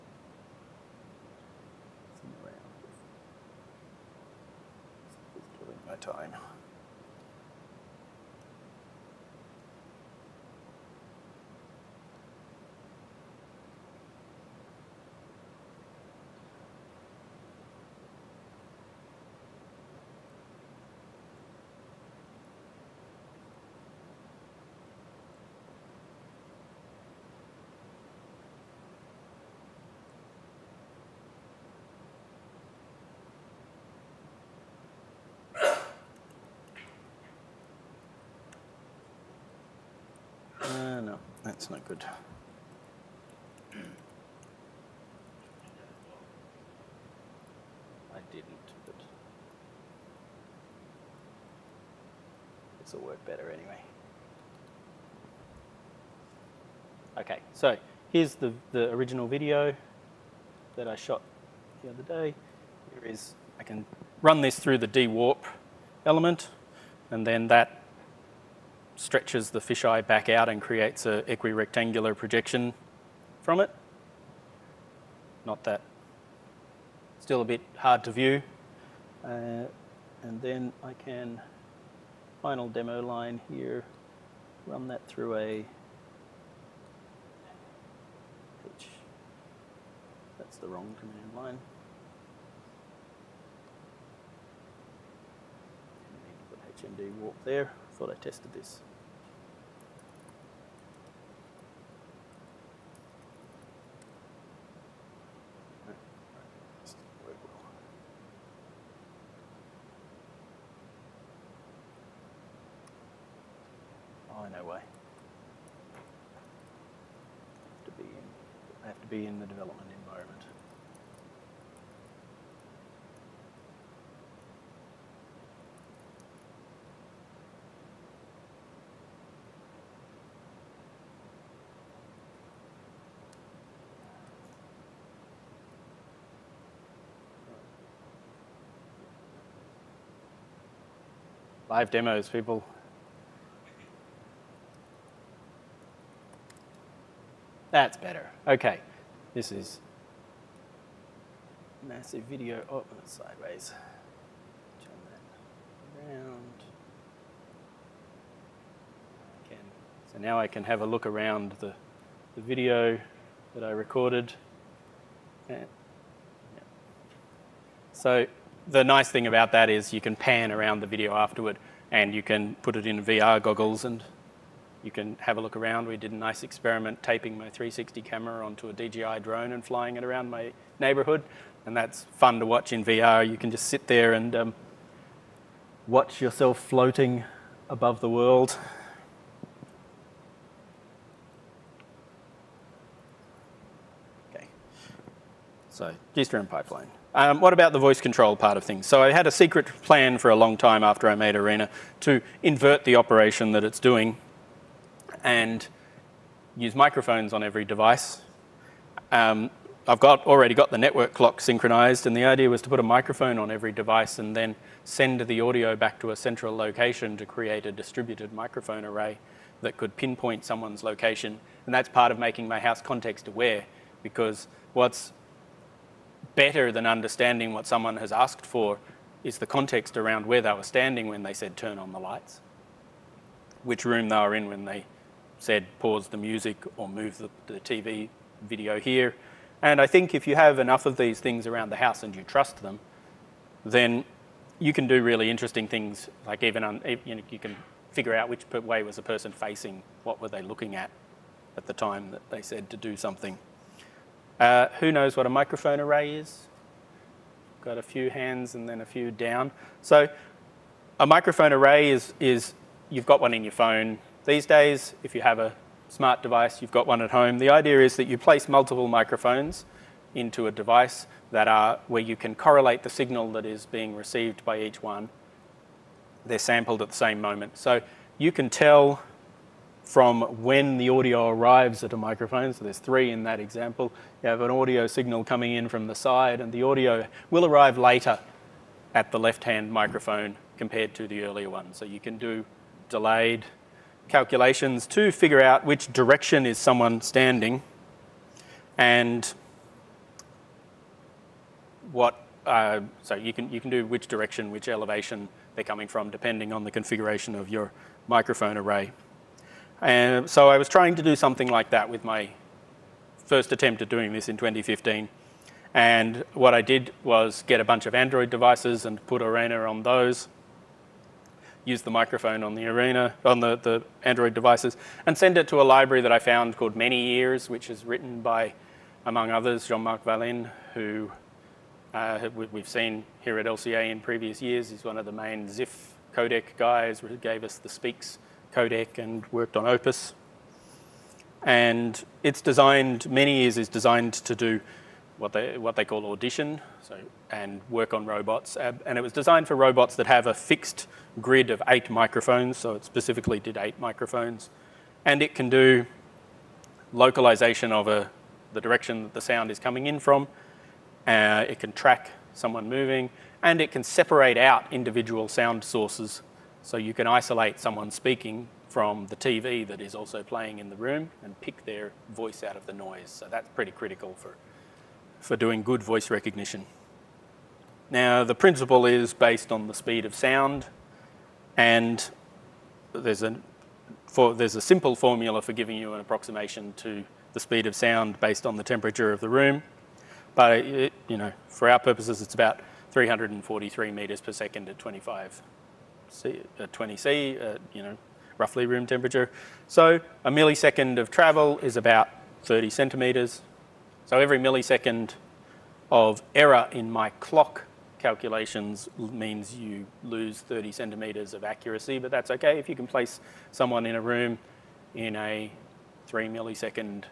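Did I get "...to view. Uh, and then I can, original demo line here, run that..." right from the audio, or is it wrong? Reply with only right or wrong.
wrong.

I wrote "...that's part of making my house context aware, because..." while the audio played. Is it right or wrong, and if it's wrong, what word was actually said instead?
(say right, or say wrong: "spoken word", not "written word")
right.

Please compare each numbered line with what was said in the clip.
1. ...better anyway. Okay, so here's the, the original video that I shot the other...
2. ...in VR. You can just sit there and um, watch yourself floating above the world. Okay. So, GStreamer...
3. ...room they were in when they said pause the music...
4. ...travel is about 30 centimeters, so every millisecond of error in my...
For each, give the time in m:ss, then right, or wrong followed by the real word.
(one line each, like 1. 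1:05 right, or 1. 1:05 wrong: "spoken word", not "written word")
1. 0:53 right
2. 3:02 right
3. 3:53 right
4. 6:41 right.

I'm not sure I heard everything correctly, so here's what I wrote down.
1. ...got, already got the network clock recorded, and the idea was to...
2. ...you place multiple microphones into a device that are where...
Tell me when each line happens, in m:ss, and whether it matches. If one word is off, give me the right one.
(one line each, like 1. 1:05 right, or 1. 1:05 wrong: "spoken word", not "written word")
1. 3:29 wrong: "synchronized", not "recorded"
2. 4:28 right.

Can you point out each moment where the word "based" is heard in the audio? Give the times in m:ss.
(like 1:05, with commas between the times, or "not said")
6:19, 6:28.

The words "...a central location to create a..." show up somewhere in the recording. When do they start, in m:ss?
3:36.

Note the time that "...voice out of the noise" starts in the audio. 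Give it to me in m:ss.
6:12.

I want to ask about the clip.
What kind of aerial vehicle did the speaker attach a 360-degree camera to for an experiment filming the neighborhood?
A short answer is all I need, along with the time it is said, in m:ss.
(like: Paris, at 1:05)
DJI drone, at 2:58.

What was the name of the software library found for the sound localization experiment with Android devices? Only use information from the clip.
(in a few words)
ManyEars.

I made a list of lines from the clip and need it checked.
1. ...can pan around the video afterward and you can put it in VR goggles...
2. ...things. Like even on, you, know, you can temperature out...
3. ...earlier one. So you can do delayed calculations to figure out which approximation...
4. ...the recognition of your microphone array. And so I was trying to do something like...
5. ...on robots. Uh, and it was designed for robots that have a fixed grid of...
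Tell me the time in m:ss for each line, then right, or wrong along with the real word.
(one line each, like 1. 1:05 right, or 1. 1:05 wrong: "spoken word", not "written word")
1. 2:50 right
2. 4:05 wrong: "figure", not "temperature"
3. 4:51 wrong: "direction", not "approximation"
4. 5:06 wrong: "configuration", not "recognition"
5. 5:47 right.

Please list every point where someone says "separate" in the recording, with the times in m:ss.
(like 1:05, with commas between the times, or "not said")
6:03.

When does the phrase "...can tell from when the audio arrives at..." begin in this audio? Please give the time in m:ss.
4:38.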